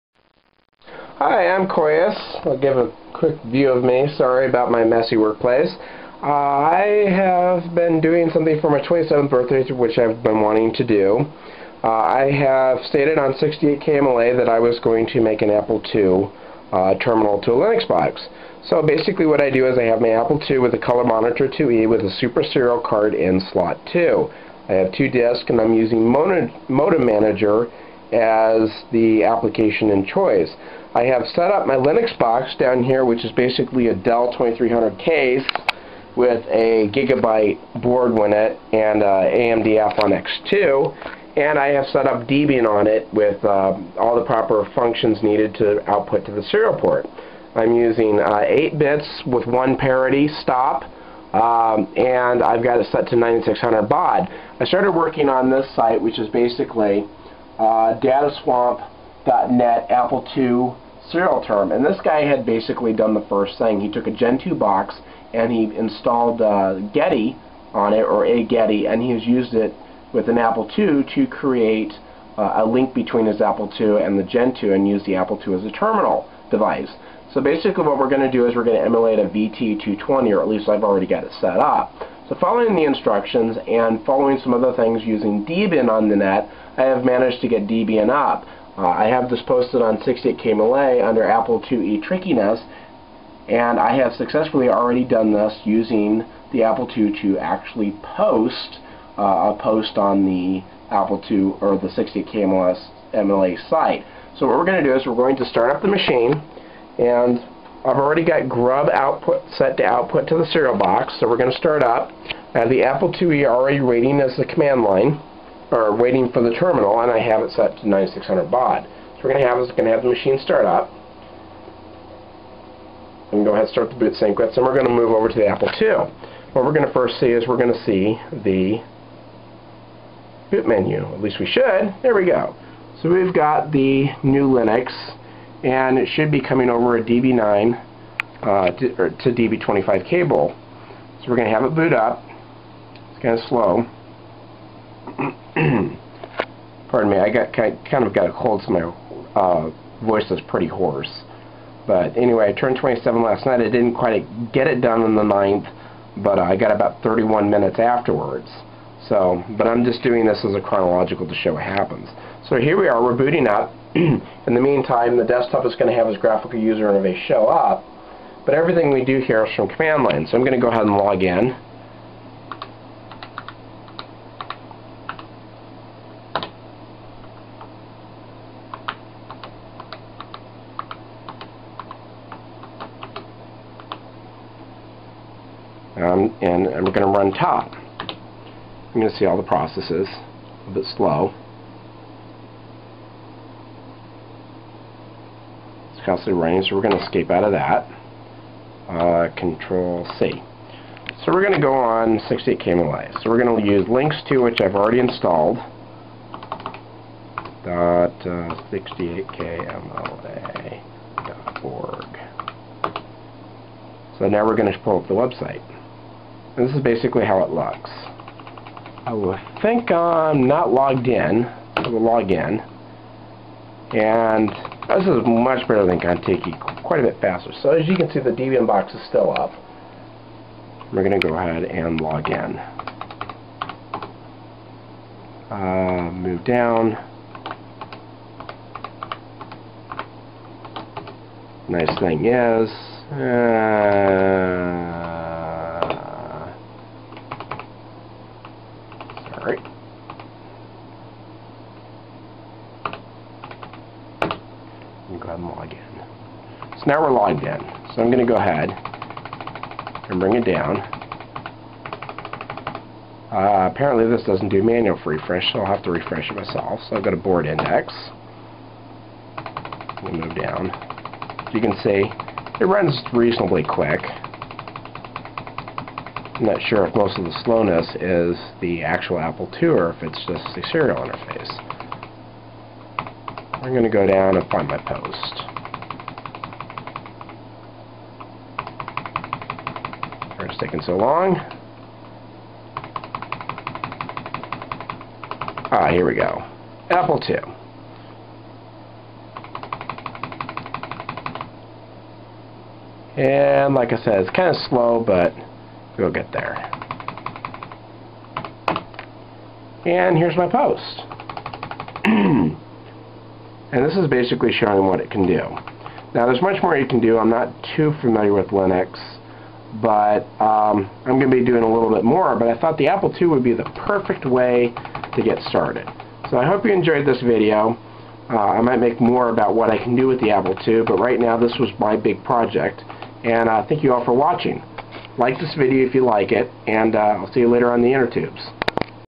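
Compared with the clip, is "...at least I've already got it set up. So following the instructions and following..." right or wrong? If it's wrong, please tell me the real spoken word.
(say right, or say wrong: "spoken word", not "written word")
right.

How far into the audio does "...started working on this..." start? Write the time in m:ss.
0:54.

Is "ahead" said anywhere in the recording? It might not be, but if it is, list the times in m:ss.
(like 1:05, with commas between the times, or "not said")
2:03, 2:50, 3:51, 4:18.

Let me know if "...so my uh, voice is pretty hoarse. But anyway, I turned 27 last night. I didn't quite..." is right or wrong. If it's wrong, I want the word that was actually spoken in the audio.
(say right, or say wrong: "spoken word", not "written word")
right.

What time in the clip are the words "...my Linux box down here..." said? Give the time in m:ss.
0:31.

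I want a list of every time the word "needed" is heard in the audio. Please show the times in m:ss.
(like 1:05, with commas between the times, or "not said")
0:45.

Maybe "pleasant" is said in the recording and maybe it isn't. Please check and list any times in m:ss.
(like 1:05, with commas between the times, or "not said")
not said.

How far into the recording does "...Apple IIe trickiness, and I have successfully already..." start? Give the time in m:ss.
1:31.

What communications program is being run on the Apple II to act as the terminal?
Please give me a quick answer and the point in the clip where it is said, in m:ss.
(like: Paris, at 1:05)
Modem Manager, at 0:26.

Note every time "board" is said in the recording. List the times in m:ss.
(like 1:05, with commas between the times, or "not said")
0:37, 4:27.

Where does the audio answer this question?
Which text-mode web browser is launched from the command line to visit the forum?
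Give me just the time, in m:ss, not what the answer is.
3:23.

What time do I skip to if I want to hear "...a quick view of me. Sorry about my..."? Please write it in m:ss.
0:02.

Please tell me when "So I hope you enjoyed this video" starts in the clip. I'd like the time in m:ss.
5:26.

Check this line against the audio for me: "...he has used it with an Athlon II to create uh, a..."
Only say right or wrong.
wrong.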